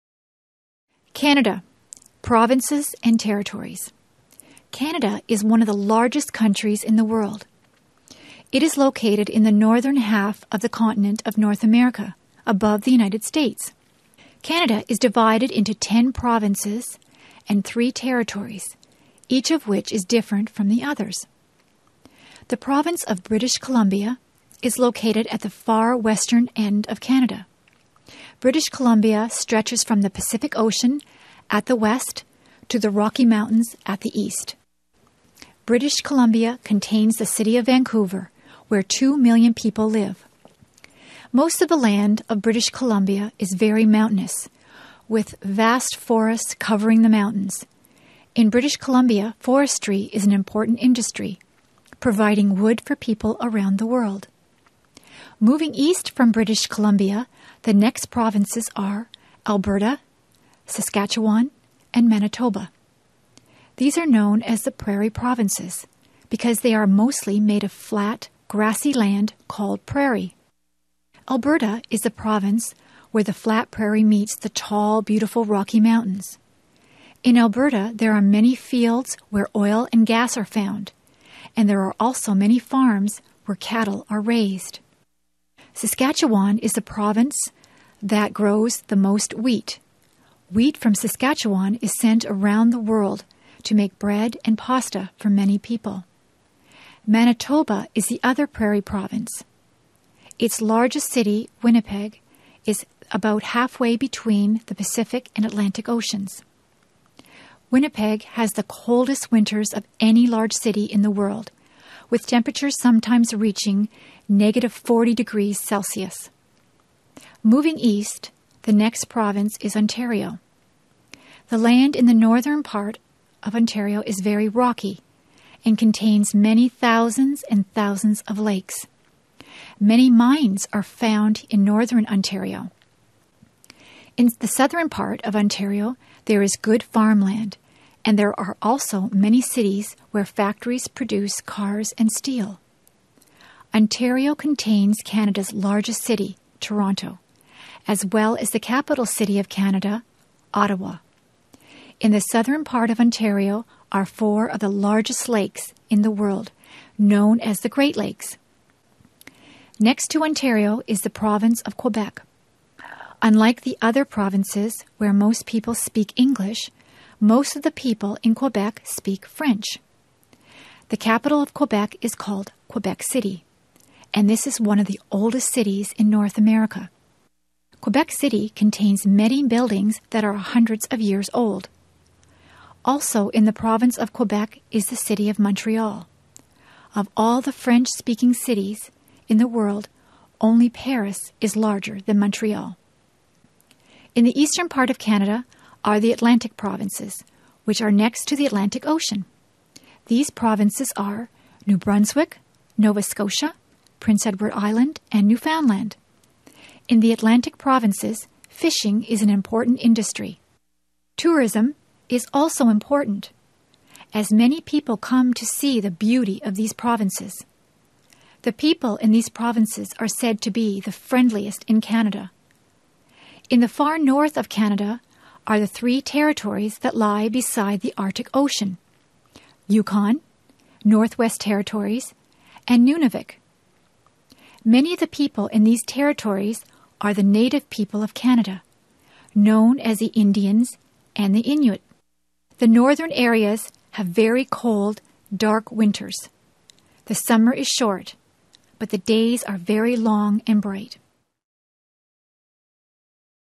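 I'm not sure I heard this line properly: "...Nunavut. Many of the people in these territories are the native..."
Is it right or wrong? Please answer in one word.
right.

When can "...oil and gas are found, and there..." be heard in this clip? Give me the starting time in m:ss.
1:19.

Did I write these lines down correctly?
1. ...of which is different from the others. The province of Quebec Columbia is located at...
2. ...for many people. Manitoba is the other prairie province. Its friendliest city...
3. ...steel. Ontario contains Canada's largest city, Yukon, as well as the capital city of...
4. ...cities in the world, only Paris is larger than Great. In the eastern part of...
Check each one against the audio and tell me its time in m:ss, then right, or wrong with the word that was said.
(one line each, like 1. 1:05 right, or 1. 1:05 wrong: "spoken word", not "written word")
1. 0:19 wrong: "British", not "Quebec"
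2. 1:35 wrong: "largest", not "friendliest"
3. 2:22 wrong: "Toronto", not "Yukon"
4. 3:08 wrong: "Montreal", not "Great".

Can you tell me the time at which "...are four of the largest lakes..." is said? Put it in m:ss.
2:33.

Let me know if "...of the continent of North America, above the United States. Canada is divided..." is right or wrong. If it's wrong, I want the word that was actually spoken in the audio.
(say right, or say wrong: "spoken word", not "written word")
right.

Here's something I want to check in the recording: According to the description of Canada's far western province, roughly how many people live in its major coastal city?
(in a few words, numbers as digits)
2 million.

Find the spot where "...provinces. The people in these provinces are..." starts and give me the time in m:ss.
3:36.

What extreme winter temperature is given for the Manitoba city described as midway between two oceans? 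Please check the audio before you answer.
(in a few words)
-40 degrees Celsius.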